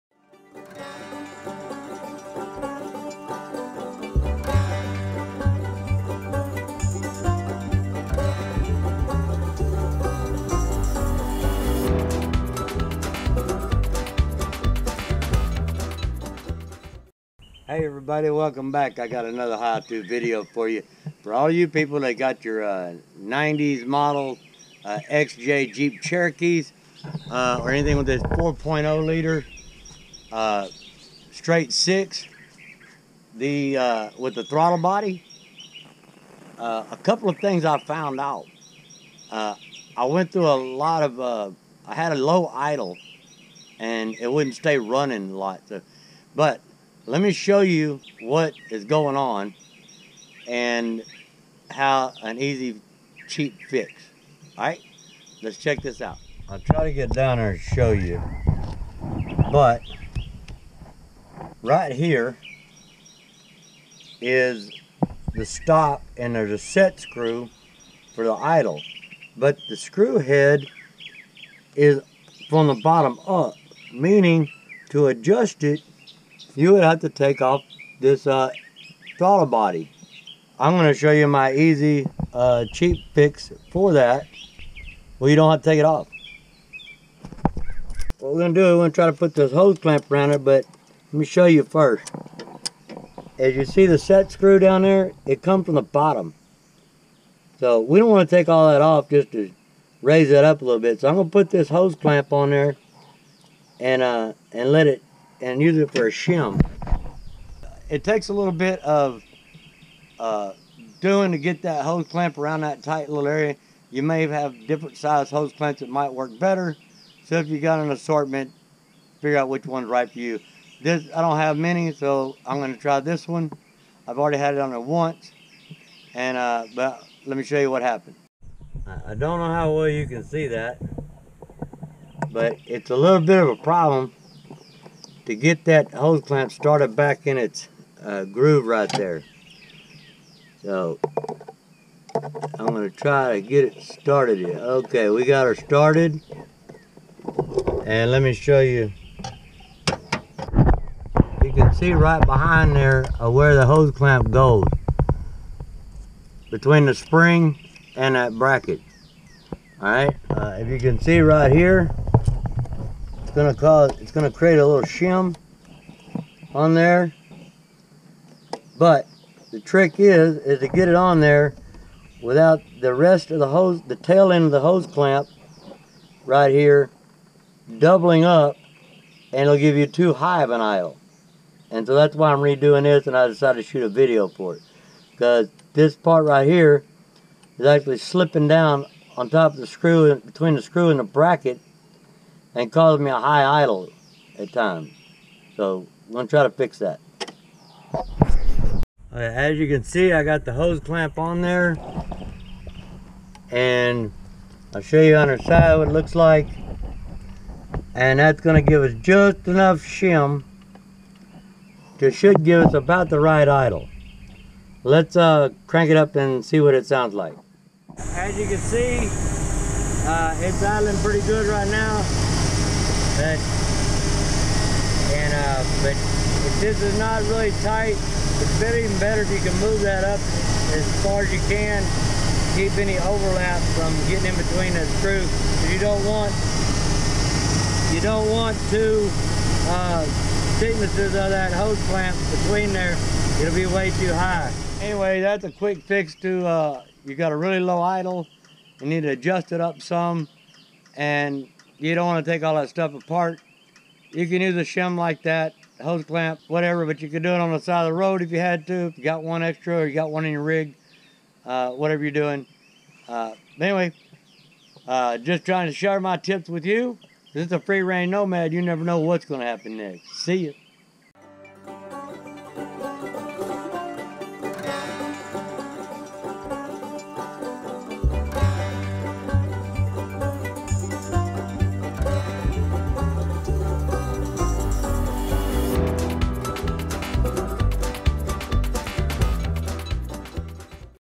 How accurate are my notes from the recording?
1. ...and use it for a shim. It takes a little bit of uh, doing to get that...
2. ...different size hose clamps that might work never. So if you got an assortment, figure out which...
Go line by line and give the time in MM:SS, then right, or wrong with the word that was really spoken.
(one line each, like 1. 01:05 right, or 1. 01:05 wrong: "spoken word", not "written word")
1. 01:45 right
2. 01:54 wrong: "better", not "never".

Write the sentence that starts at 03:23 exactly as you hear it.
And I'll show you on her side what it looks like.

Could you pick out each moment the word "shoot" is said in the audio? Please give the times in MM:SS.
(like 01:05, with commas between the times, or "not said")
03:03.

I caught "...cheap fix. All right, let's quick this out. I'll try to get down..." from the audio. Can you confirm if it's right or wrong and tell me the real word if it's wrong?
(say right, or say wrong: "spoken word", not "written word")
wrong: "check", not "quick".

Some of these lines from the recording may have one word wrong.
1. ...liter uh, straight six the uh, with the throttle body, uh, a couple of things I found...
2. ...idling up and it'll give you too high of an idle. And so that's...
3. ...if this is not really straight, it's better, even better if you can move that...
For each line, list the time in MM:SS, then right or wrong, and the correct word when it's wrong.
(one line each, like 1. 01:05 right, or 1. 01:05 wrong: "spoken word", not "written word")
1. 00:29 right
2. 02:57 wrong: "doubling", not "idling"
3. 03:46 wrong: "tight", not "straight".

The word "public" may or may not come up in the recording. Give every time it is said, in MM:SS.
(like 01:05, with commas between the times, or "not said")
not said.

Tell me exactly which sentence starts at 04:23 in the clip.
Uh, anyway, uh, just trying to share my tips with you.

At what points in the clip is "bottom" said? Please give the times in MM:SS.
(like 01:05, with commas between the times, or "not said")
01:12, 01:35.